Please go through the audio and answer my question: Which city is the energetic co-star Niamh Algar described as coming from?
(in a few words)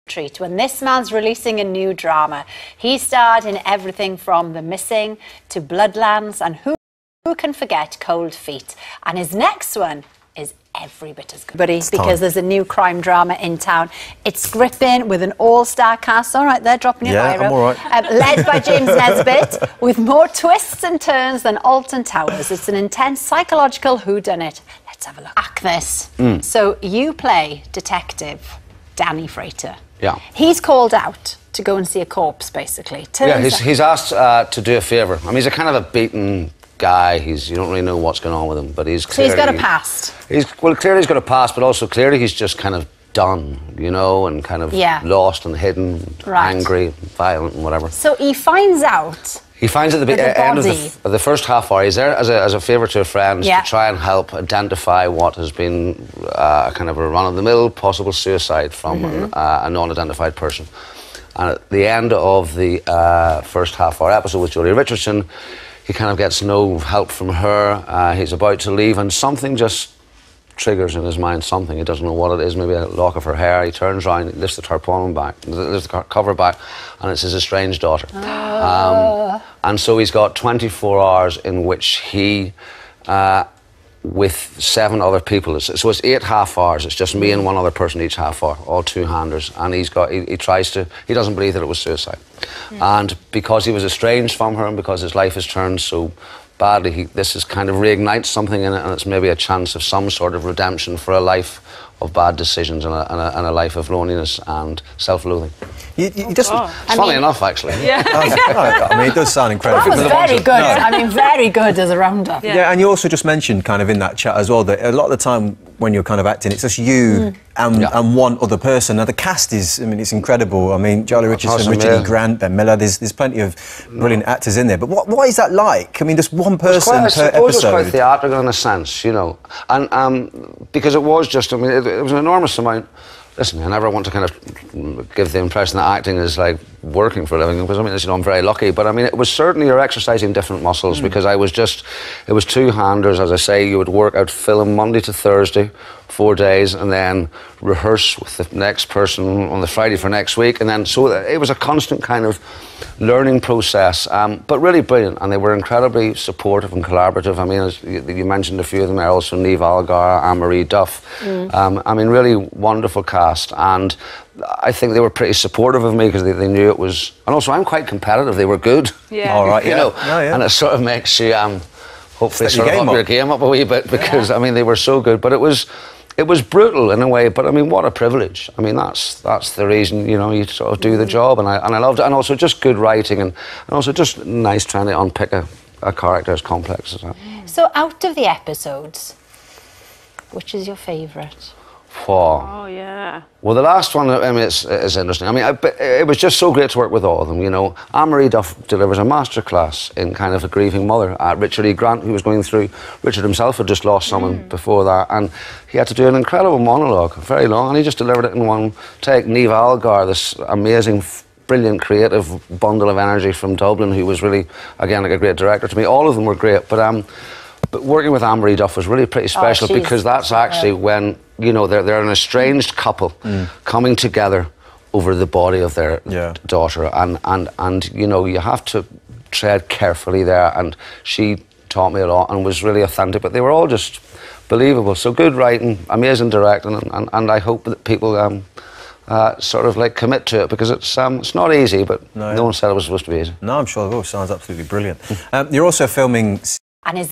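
Dublin.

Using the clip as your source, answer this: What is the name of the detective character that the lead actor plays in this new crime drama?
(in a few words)
Danny Frater.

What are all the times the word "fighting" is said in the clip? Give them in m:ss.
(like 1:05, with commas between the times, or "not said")
not said.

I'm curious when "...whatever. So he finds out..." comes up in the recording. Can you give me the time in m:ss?
0:47.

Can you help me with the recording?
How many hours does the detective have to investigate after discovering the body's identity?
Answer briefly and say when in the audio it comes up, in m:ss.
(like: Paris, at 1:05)
24, at 1:20.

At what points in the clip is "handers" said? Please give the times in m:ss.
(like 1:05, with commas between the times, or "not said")
1:29, 2:22.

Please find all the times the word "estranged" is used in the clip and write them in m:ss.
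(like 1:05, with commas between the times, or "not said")
1:17, 1:33, 3:42.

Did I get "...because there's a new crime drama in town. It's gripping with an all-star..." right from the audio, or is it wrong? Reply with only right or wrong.
right.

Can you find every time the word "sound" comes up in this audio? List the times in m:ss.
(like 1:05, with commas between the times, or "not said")
1:49, 4:04.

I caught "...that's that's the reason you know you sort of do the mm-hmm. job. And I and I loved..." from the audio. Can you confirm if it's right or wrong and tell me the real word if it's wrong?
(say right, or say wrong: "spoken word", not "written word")
right.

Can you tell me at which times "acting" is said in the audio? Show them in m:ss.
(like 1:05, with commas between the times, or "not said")
1:56, 2:15.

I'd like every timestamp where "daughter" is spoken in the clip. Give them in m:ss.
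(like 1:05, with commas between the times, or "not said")
1:17, 3:46.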